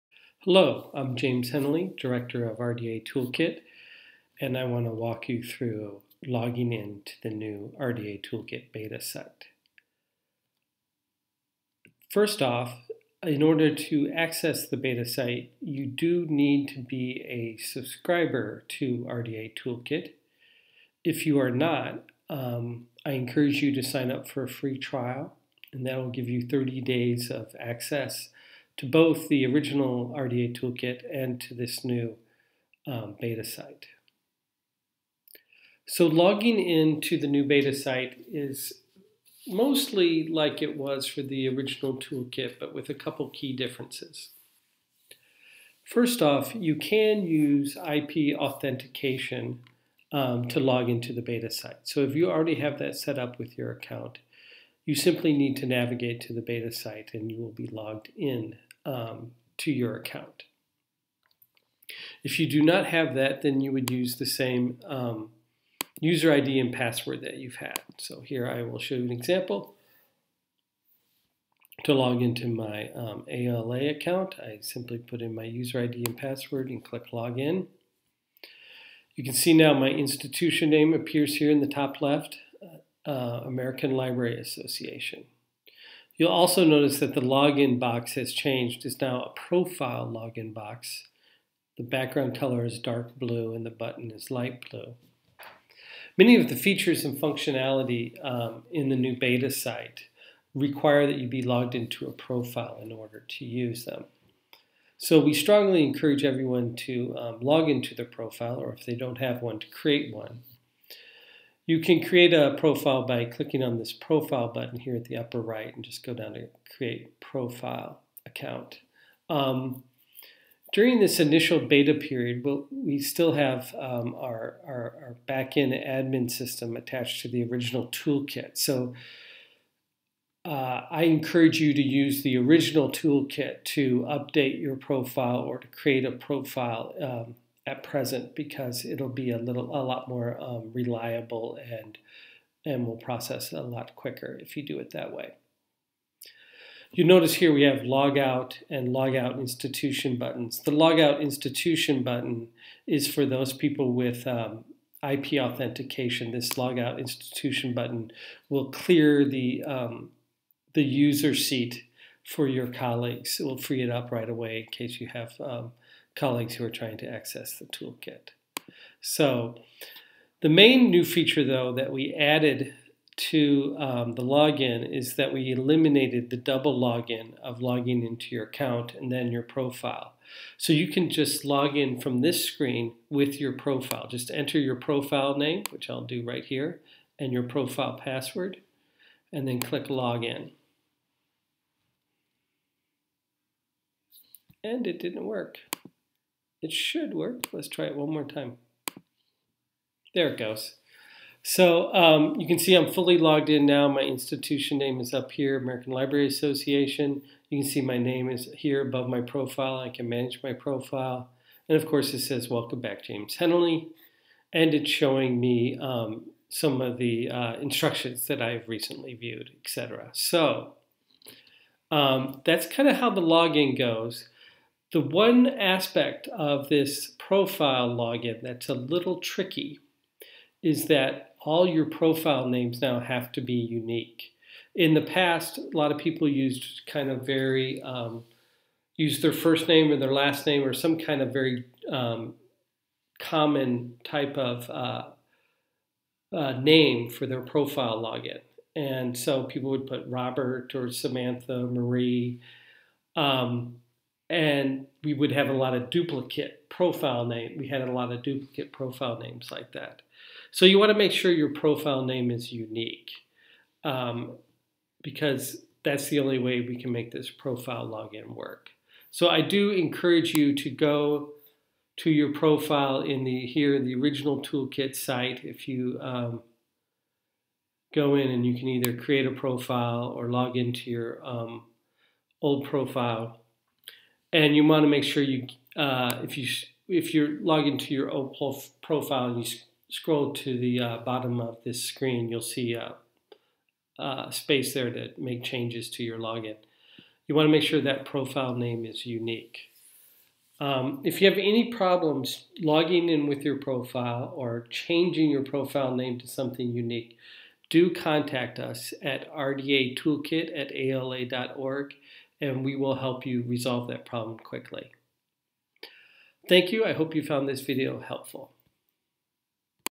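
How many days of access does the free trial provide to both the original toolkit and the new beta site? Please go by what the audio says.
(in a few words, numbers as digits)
30.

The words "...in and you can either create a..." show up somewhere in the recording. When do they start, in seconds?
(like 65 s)
278 s.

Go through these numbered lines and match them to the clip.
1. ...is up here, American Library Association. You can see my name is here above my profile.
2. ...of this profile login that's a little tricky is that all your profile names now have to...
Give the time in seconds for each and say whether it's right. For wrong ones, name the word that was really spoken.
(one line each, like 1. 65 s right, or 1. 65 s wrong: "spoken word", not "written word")
1. 204 s right
2. 226 s right.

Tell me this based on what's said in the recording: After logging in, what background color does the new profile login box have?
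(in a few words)
Dark blue.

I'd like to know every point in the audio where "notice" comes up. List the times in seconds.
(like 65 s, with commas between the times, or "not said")
86 s, 147 s.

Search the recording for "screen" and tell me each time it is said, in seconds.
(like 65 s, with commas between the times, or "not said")
182 s, 291 s.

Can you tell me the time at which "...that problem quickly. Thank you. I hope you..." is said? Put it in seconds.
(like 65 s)
313 s.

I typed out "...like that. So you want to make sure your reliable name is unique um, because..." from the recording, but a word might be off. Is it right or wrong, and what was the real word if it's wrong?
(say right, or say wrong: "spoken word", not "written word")
wrong: "profile", not "reliable".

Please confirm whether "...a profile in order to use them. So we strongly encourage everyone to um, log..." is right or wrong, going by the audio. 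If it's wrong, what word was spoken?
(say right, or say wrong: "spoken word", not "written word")
right.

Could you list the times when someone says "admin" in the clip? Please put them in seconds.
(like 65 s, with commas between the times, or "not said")
125 s.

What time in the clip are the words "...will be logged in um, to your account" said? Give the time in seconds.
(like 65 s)
57 s.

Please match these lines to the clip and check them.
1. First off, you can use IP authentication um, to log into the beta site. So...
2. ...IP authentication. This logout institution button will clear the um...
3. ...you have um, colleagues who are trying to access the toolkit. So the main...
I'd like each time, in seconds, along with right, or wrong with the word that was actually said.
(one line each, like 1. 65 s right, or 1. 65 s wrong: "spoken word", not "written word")
1. 45 s right
2. 155 s right
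3. 165 s right.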